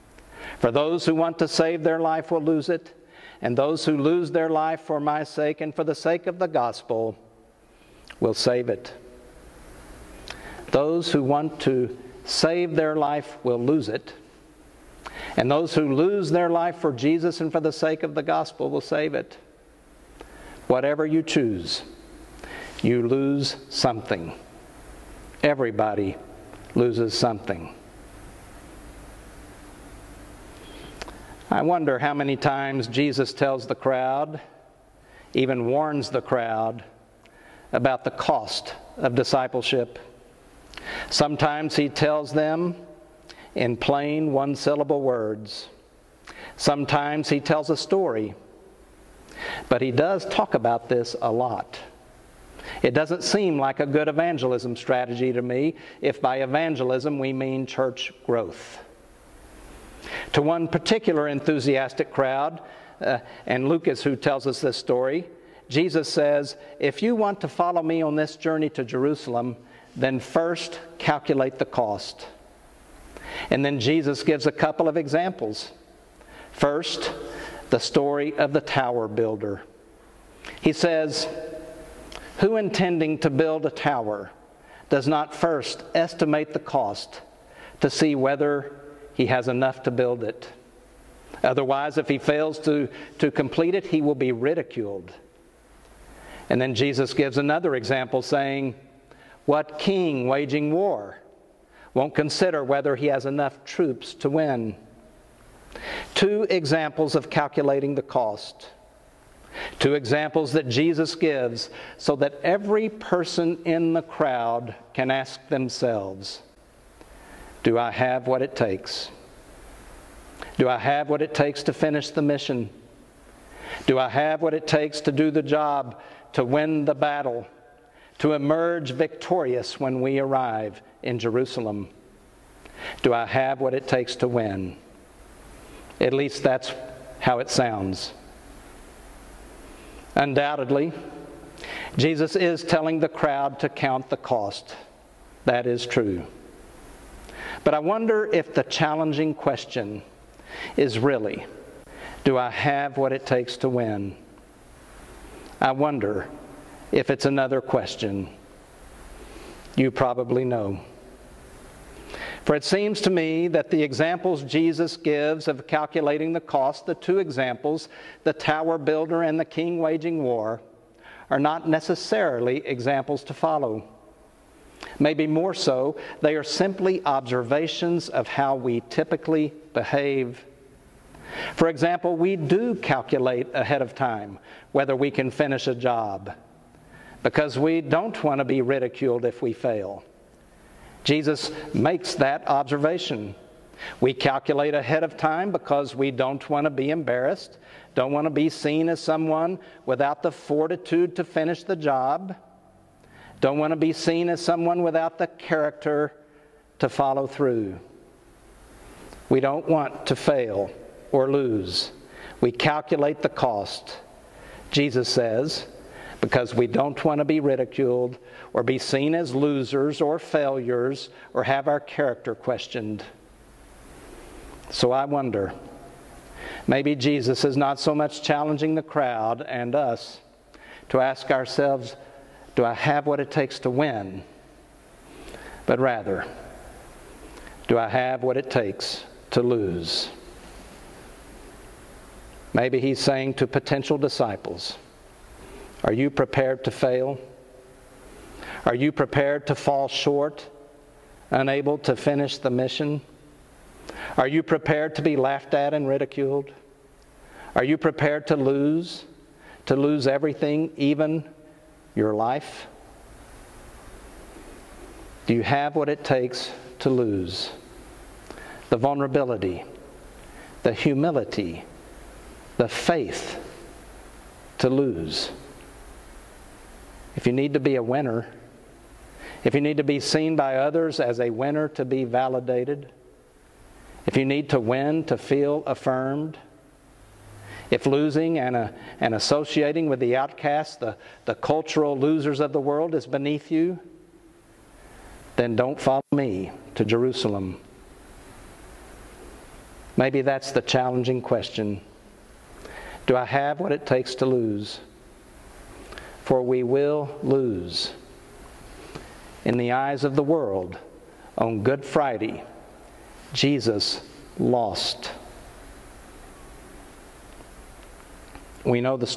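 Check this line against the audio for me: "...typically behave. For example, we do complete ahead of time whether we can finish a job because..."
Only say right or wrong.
wrong.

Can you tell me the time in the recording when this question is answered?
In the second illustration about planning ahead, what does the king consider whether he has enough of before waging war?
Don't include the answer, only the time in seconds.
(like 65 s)
103 s.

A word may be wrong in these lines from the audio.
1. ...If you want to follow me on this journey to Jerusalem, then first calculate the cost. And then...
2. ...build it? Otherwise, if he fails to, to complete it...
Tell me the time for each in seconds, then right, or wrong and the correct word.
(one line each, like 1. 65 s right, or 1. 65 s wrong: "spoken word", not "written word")
1. 66 s right
2. 89 s right.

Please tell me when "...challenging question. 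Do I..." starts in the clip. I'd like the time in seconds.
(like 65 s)
300 s.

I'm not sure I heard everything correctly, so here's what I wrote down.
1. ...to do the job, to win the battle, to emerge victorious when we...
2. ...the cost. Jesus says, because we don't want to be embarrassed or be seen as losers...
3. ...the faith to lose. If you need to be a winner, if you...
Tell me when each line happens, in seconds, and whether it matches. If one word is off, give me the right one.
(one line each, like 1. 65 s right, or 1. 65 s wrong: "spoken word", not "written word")
1. 125 s right
2. 213 s wrong: "ridiculed", not "embarrassed"
3. 272 s right.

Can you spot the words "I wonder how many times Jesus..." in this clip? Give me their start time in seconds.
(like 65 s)
31 s.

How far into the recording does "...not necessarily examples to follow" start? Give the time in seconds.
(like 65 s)
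171 s.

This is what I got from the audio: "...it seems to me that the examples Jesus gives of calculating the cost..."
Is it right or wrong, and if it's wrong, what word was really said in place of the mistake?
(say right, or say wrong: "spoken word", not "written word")
right.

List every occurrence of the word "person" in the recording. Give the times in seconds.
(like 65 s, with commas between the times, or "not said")
112 s.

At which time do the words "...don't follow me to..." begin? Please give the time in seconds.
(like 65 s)
295 s.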